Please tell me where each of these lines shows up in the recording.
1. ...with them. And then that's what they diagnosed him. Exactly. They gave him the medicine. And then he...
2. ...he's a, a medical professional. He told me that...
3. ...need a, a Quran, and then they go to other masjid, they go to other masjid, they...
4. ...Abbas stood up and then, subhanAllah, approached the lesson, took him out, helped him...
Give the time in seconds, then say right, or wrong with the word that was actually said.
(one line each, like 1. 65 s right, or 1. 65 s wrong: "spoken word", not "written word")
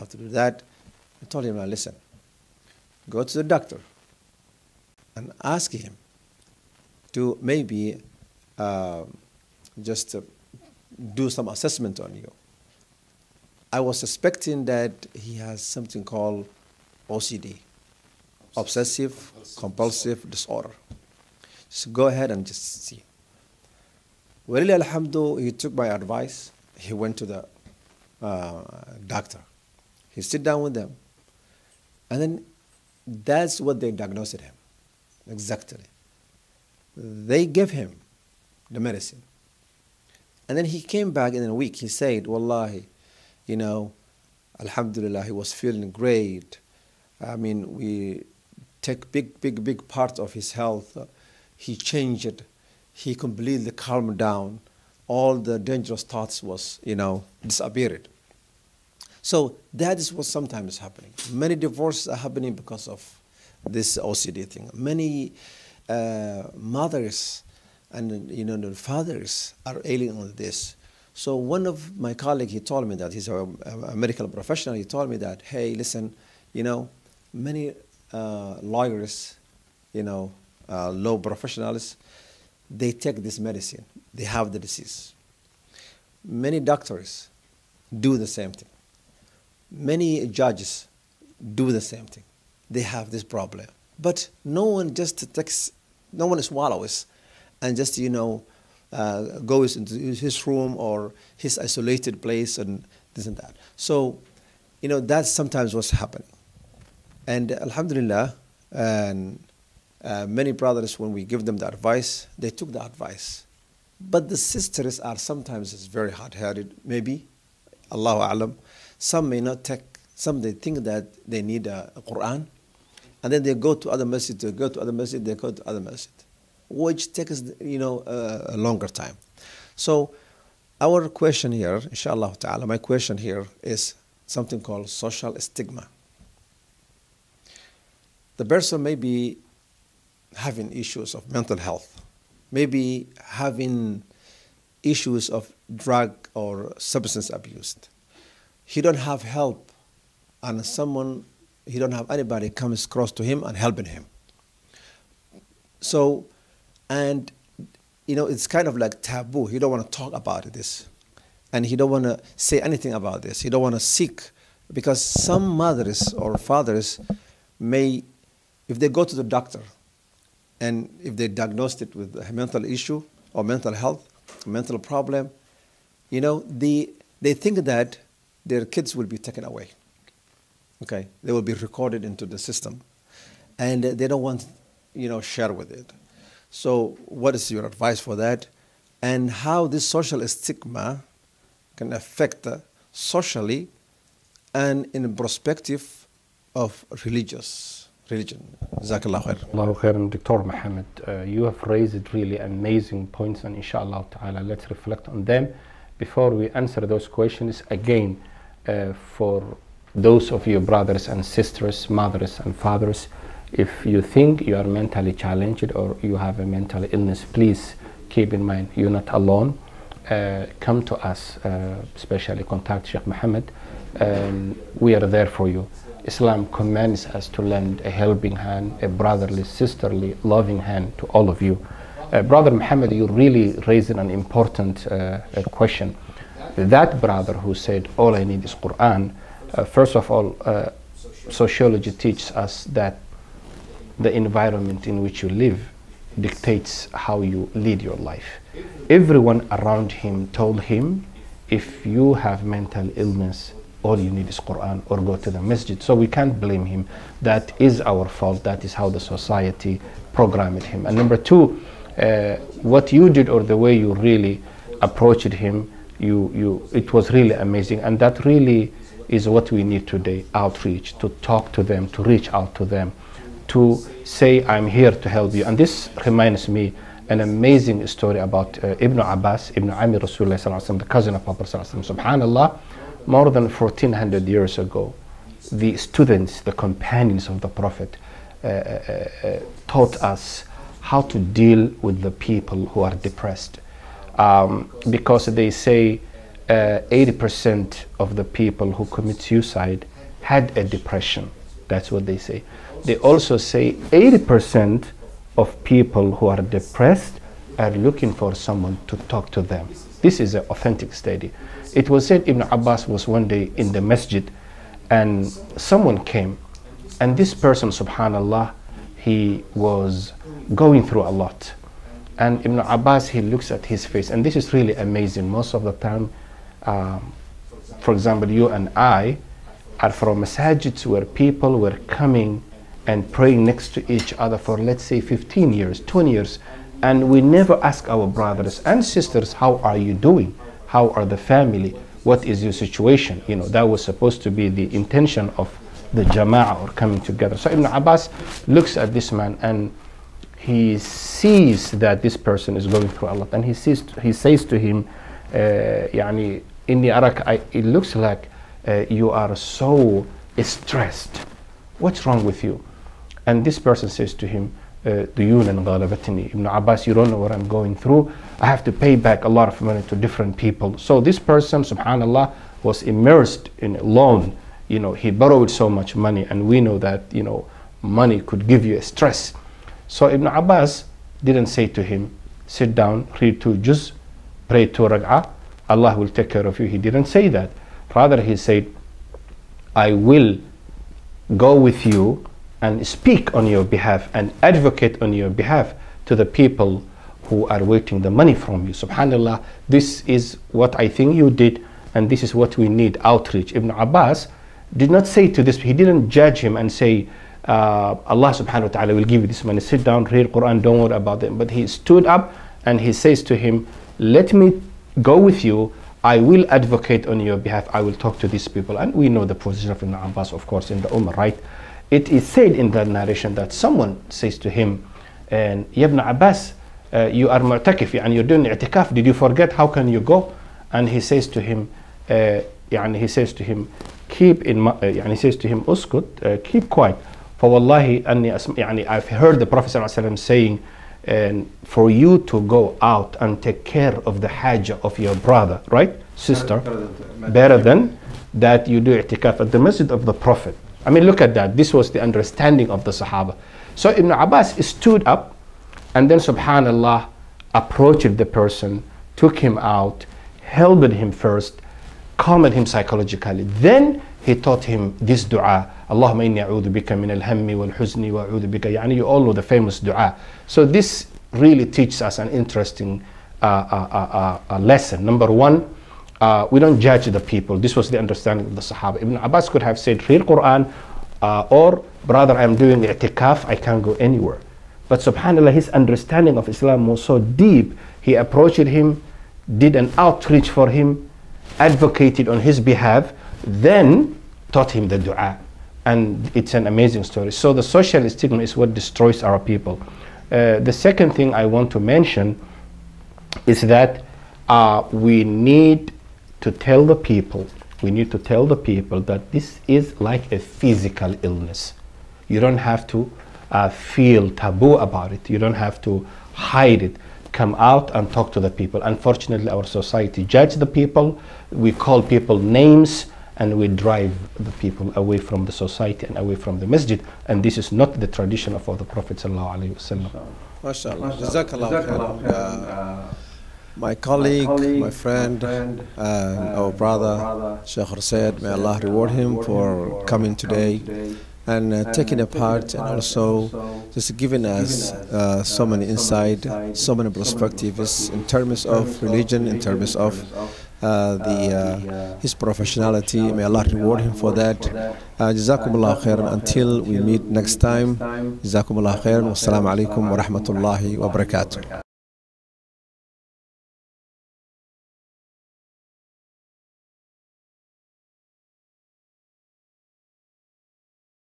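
1. 30 s right
2. 73 s right
3. 121 s right
4. 454 s wrong: "person", not "lesson".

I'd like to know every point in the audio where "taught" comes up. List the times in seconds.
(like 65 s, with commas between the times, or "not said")
289 s, 464 s, 494 s.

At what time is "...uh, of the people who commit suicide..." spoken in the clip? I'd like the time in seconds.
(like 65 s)
297 s.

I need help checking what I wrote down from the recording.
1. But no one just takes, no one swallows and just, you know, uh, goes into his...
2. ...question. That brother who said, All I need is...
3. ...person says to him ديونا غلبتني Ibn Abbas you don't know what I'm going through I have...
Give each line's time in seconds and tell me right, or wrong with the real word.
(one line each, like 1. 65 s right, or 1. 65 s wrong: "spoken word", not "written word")
1. 93 s right
2. 235 s right
3. 363 s right.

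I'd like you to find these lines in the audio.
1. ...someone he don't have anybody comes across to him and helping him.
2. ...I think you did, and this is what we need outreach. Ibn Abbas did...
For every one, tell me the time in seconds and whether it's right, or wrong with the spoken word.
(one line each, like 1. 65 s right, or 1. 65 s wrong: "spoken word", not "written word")
1. 150 s right
2. 400 s right.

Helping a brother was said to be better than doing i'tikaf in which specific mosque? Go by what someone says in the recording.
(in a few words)
The Masjid of the Prophet.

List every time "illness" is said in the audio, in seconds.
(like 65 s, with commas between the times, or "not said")
216 s, 252 s, 511 s.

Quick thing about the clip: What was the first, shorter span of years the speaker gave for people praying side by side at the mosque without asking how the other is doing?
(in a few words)
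15 years.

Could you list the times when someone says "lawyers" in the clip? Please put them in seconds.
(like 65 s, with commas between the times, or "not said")
78 s.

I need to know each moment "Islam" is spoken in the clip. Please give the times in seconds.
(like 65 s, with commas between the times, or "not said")
226 s, 486 s.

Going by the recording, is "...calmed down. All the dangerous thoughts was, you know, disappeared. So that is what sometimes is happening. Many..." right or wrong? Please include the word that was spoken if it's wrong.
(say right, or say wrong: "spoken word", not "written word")
right.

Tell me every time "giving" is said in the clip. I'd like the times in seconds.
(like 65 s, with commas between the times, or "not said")
544 s.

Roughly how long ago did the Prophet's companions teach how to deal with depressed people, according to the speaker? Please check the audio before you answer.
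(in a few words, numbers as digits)
More than 1400 years.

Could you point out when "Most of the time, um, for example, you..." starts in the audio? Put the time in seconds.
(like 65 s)
325 s.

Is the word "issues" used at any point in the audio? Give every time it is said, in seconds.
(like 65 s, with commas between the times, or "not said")
140 s, 144 s, 172 s.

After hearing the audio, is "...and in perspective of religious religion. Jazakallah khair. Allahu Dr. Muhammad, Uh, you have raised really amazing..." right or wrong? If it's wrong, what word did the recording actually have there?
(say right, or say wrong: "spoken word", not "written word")
right.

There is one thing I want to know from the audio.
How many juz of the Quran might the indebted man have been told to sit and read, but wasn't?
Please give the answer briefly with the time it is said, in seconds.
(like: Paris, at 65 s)
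2, at 383 s.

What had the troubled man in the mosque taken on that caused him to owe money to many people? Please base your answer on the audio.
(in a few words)
A loan.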